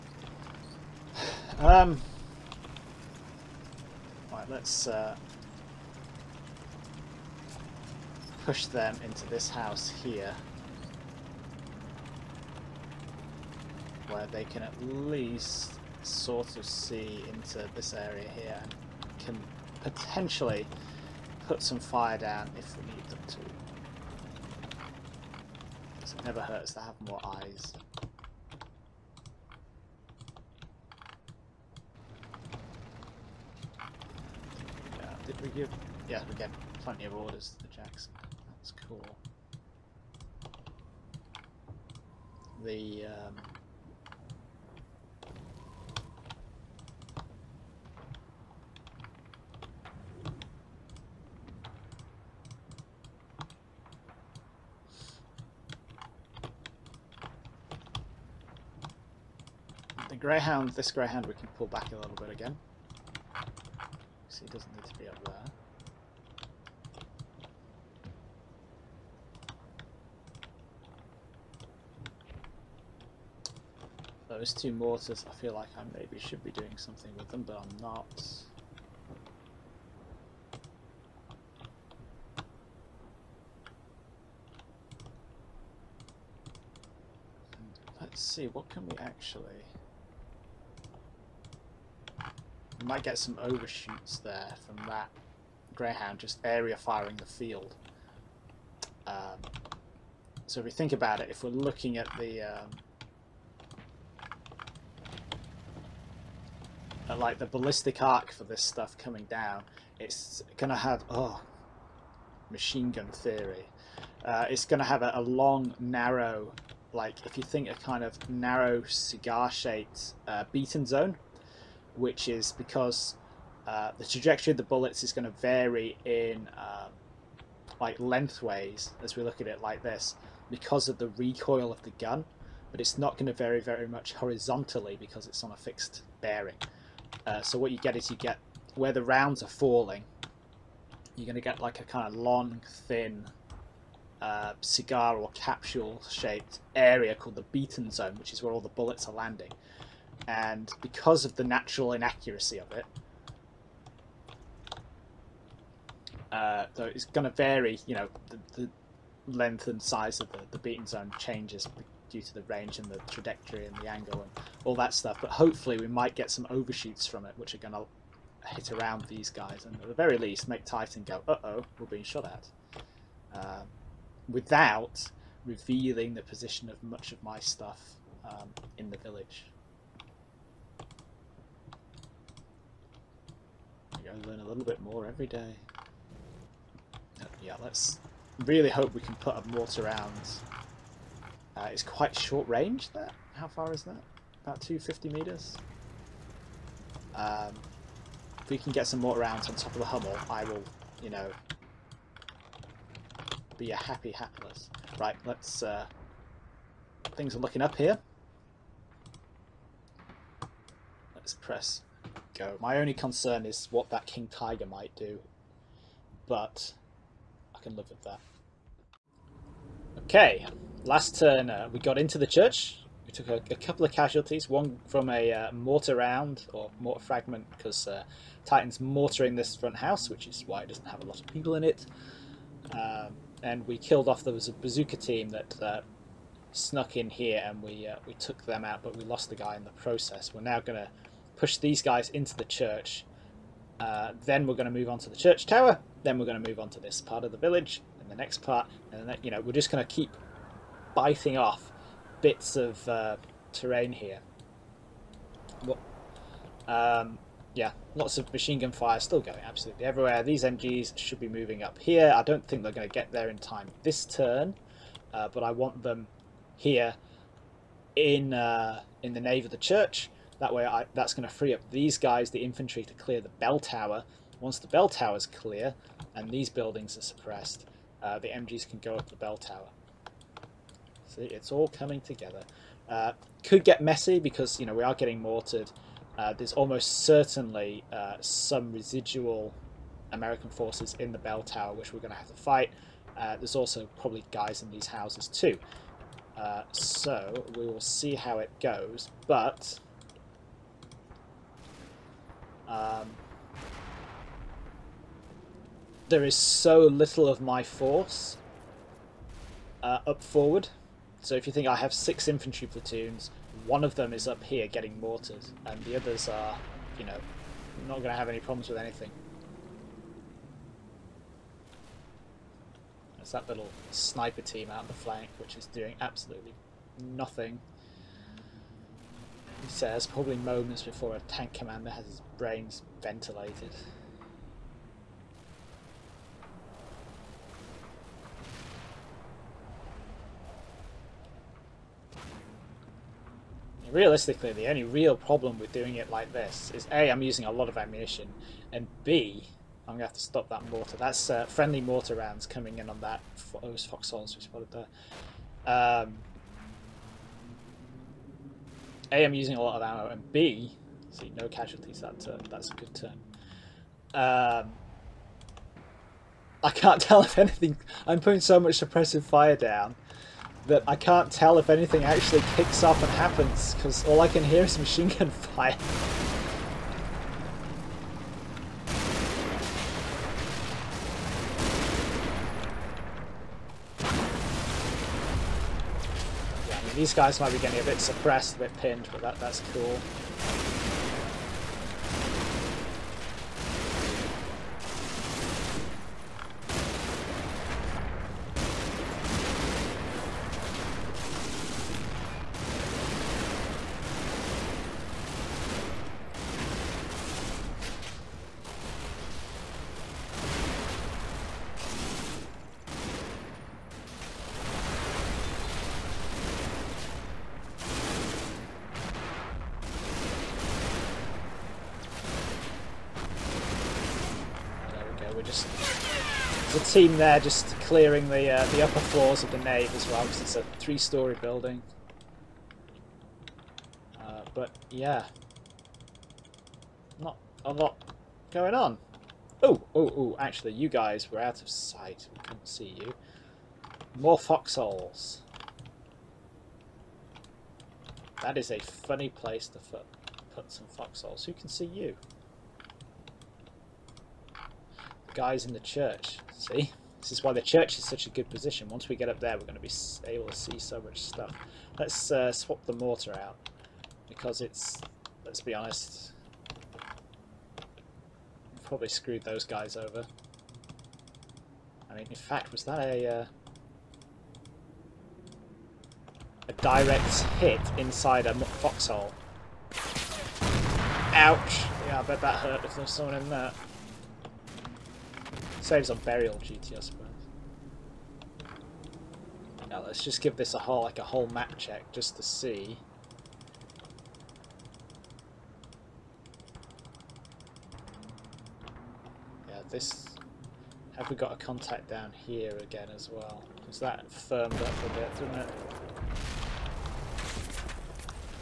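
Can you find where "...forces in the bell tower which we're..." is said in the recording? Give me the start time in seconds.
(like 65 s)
290 s.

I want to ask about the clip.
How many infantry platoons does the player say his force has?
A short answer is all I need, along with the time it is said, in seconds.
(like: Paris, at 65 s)
6, at 311 s.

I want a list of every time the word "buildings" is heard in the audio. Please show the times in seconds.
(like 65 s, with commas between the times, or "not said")
276 s, 431 s.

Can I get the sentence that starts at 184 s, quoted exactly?
and learn a little bit more every day.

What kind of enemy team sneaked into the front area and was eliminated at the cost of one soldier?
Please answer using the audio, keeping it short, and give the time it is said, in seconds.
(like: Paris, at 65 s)
bazooka team, at 234 s.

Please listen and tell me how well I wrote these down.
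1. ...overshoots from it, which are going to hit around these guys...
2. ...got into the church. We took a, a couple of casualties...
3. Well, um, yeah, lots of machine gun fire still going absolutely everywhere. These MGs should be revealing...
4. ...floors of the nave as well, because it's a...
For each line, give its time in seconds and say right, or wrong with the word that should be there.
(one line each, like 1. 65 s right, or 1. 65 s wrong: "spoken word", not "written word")
1. 166 s right
2. 221 s right
3. 255 s wrong: "moving", not "revealing"
4. 428 s right.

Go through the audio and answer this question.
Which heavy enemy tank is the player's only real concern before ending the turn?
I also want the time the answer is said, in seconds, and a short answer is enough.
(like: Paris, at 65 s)
King Tiger, at 214 s.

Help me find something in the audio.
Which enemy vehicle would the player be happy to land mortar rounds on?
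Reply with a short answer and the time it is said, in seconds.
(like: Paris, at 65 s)
Hummel, at 199 s.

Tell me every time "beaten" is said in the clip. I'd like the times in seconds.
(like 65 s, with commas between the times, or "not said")
120 s, 147 s, 160 s.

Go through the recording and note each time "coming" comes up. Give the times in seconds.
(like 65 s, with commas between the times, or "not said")
108 s, 281 s, 352 s.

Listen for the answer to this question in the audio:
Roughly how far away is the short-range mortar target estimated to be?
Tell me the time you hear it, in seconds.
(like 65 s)
194 s.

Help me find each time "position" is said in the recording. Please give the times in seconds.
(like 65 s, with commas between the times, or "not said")
176 s, 458 s.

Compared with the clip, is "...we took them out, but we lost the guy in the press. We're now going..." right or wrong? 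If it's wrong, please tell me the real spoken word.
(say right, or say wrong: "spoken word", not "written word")
wrong: "process", not "press".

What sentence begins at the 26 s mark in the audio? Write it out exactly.
it never hurts to have more eyes.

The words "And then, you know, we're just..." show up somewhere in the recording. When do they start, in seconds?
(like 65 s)
248 s.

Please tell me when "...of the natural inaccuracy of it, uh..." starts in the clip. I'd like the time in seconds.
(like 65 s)
151 s.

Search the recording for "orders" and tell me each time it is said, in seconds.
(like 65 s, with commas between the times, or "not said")
37 s.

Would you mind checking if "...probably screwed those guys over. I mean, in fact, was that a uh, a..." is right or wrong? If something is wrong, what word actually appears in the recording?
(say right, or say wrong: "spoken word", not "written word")
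right.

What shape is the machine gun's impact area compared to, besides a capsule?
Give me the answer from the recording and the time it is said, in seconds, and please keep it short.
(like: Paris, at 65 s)
cigar, at 144 s.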